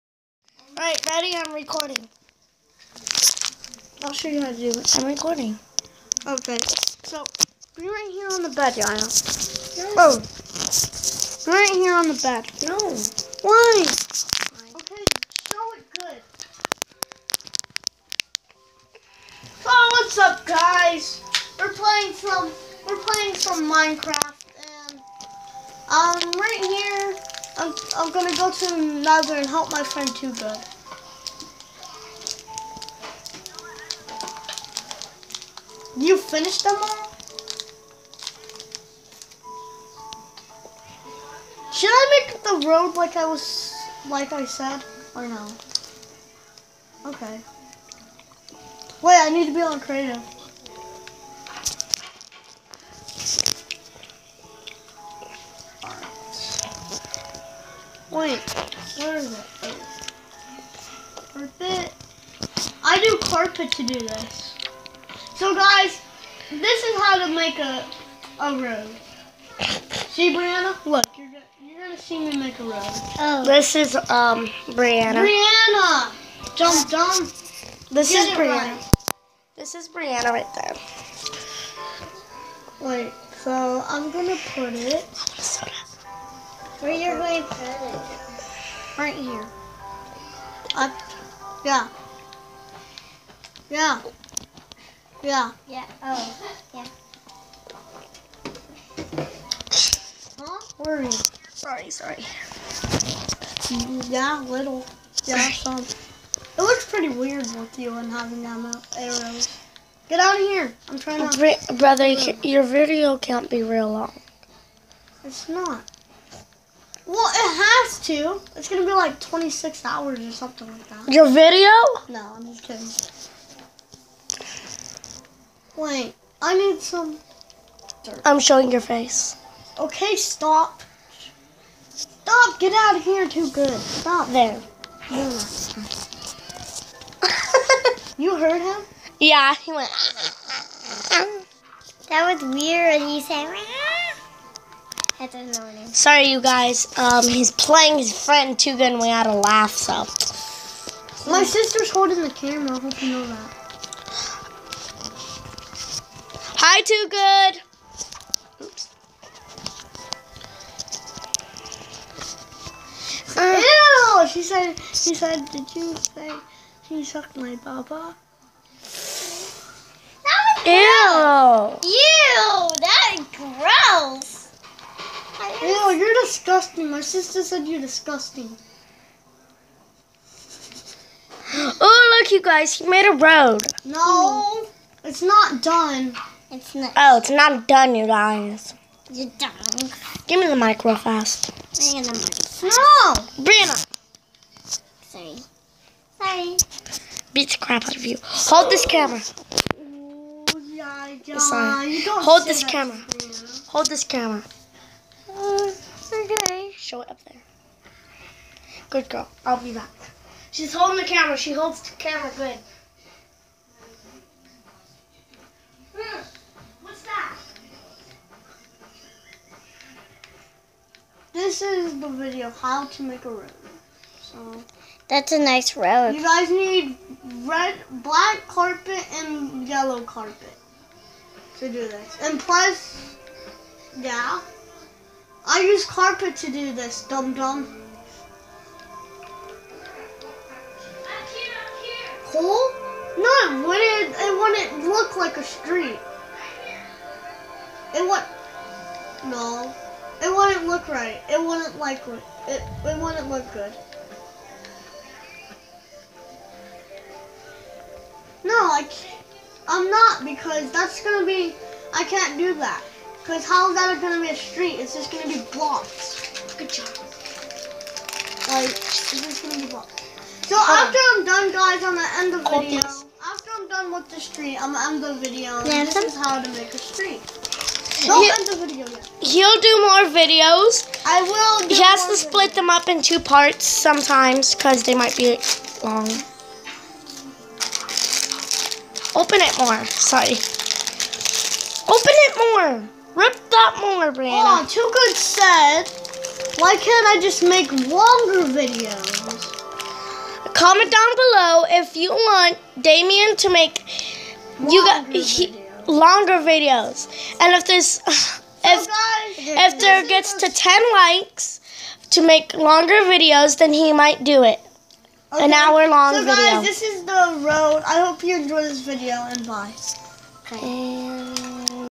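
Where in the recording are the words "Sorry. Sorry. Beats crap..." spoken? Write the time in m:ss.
3:15.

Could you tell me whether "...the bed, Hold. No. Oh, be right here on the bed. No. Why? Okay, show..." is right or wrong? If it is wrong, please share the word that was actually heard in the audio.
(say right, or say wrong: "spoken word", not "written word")
wrong: "Yana", not "Hold".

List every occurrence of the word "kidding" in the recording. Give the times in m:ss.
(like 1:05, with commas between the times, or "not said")
2:04.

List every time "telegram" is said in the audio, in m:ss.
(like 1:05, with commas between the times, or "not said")
not said.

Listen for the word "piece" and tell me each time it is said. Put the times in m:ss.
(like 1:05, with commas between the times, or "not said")
not said.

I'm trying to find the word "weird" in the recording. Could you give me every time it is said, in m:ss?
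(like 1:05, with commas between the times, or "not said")
1:47, 2:22.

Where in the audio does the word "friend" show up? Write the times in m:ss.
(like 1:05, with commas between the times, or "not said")
0:29, 2:28.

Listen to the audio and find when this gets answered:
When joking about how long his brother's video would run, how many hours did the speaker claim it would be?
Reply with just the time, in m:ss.
1:59.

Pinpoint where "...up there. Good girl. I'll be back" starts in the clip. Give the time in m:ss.
3:27.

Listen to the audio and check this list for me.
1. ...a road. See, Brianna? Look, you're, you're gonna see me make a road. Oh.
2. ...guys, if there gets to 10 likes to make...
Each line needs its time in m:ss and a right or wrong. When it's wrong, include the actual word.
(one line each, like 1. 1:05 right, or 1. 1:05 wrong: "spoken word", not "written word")
1. 1:08 right
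2. 5:08 right.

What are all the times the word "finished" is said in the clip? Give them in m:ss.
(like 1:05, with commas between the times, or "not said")
0:36.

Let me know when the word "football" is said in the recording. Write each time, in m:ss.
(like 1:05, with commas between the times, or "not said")
not said.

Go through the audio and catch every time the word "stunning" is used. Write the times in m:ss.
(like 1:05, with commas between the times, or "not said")
not said.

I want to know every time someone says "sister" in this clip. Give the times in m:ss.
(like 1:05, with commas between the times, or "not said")
2:31, 2:57.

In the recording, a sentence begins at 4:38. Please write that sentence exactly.
Don't he, end the video yet.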